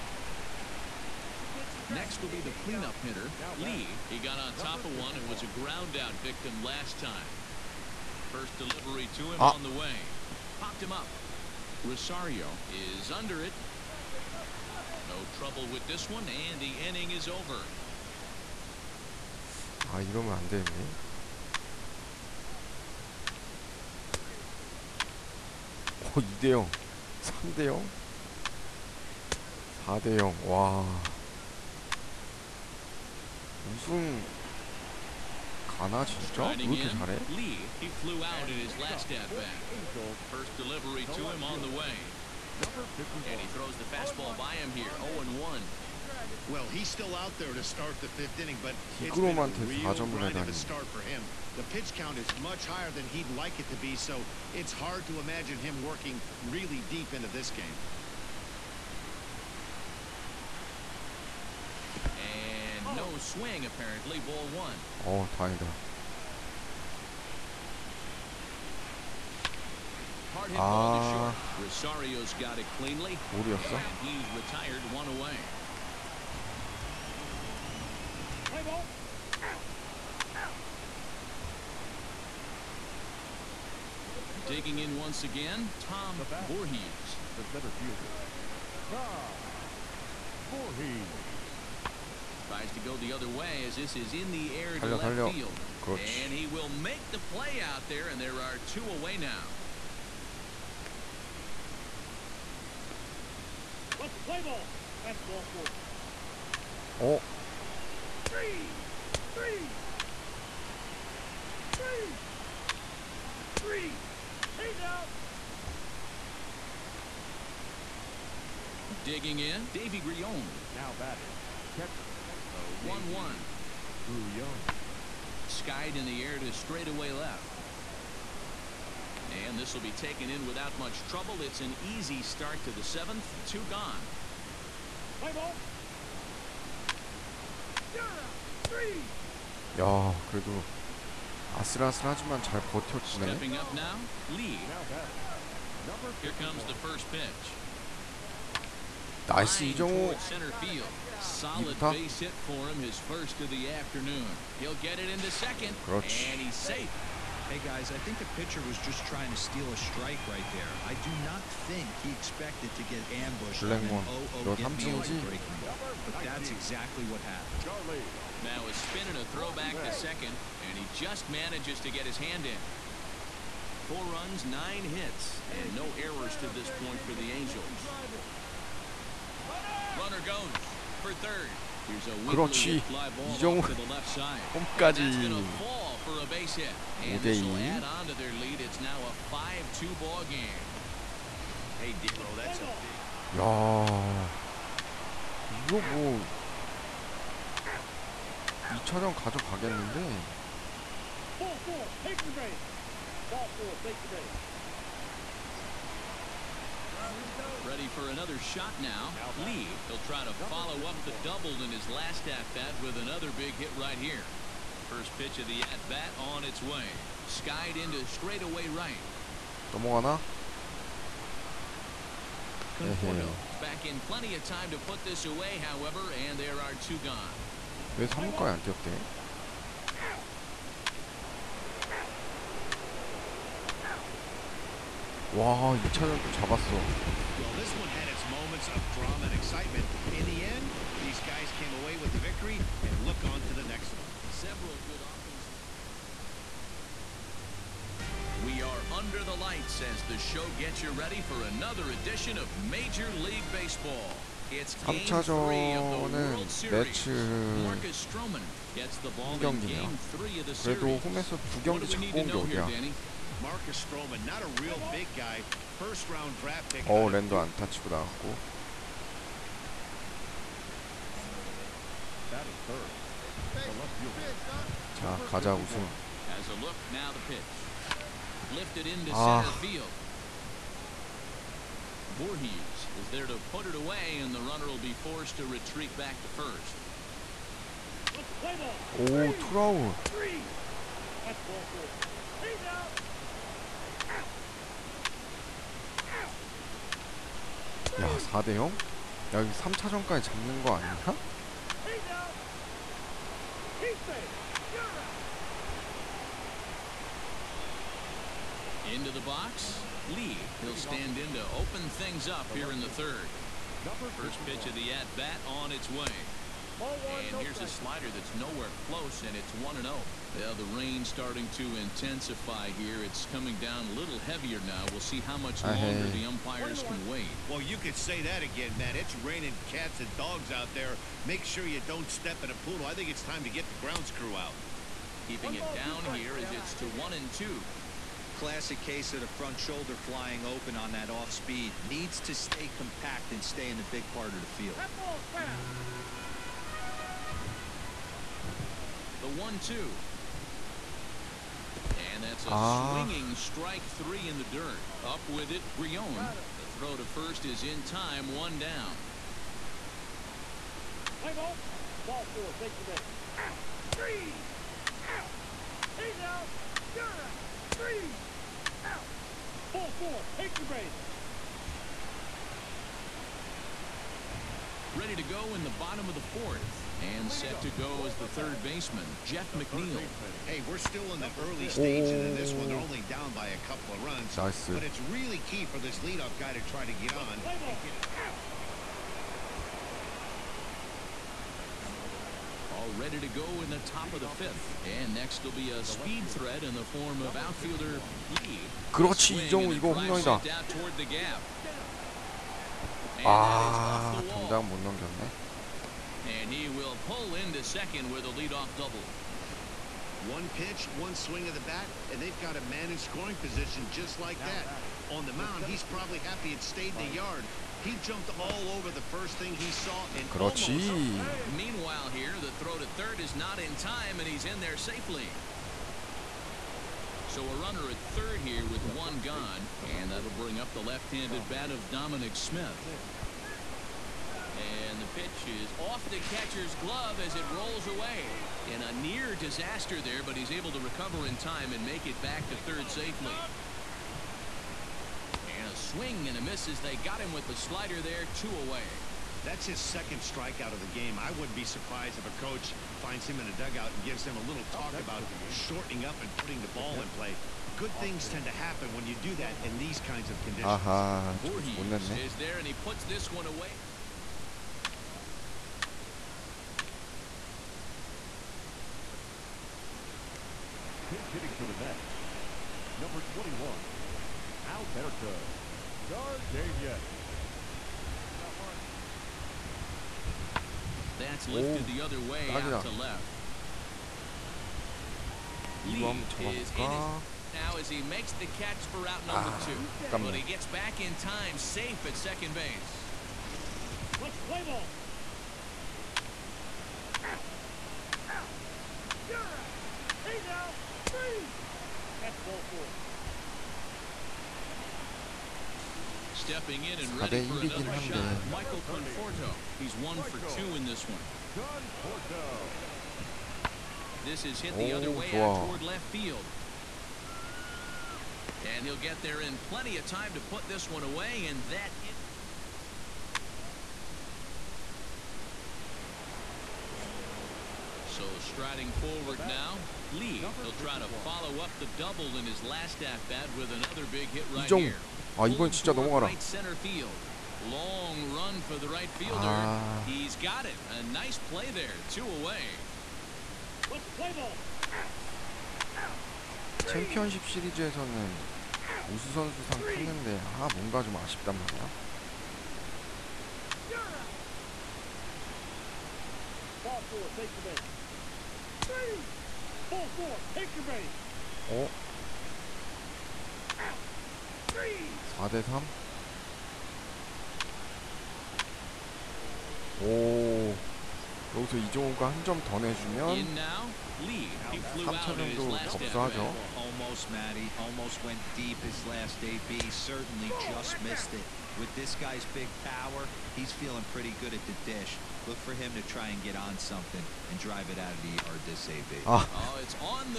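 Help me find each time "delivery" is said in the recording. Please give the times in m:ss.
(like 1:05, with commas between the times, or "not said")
0:08, 0:40.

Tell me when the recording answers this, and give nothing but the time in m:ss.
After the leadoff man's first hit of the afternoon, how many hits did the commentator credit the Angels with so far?
2:54.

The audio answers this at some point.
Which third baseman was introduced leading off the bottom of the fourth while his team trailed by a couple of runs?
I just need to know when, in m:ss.
6:19.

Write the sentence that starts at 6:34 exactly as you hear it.
And next will be a speed threat in the form of outfielder Lee.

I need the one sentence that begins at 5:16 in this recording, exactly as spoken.
And here's a slider that's nowhere close, and it's 1 0.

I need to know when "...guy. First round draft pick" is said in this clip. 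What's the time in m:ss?
4:25.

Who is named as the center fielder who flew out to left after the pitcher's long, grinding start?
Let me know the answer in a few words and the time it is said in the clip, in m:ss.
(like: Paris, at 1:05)
Tom Voorhees, at 1:28.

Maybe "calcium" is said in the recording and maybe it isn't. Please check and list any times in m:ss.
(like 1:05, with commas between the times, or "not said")
not said.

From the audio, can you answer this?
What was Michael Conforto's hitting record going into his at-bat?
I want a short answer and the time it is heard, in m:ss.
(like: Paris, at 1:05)
1 for 2, at 8:29.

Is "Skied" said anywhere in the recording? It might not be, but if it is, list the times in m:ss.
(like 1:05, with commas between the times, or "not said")
2:05, 3:37.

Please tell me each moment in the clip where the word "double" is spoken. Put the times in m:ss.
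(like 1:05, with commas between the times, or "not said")
3:31, 6:48, 8:51.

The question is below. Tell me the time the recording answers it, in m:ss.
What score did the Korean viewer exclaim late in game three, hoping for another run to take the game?
9:24.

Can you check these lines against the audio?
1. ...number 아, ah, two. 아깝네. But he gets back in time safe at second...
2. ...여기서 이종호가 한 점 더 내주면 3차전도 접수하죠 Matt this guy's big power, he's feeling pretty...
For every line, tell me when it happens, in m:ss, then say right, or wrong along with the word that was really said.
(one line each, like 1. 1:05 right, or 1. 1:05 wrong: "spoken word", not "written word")
1. 8:09 right
2. 9:31 wrong: "With", not "Matt".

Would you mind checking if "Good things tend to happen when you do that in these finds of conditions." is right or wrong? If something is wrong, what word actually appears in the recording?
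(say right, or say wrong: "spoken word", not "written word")
wrong: "kinds", not "finds".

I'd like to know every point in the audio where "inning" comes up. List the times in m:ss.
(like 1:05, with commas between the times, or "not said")
0:16, 0:48.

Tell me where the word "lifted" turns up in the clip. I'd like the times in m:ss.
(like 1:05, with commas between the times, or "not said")
4:38, 8:01.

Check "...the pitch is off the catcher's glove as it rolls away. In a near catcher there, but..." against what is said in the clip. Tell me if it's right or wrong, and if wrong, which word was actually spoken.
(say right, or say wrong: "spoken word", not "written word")
wrong: "disaster", not "catcher".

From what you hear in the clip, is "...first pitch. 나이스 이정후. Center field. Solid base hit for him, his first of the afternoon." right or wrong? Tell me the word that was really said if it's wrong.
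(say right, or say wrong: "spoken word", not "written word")
right.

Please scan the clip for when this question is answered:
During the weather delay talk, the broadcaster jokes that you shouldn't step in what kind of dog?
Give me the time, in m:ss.
5:32.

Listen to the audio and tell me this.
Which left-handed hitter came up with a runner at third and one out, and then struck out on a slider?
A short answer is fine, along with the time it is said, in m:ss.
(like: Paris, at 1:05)
Dominic Smith, at 7:11.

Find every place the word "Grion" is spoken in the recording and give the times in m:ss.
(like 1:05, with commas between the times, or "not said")
2:00, 5:55.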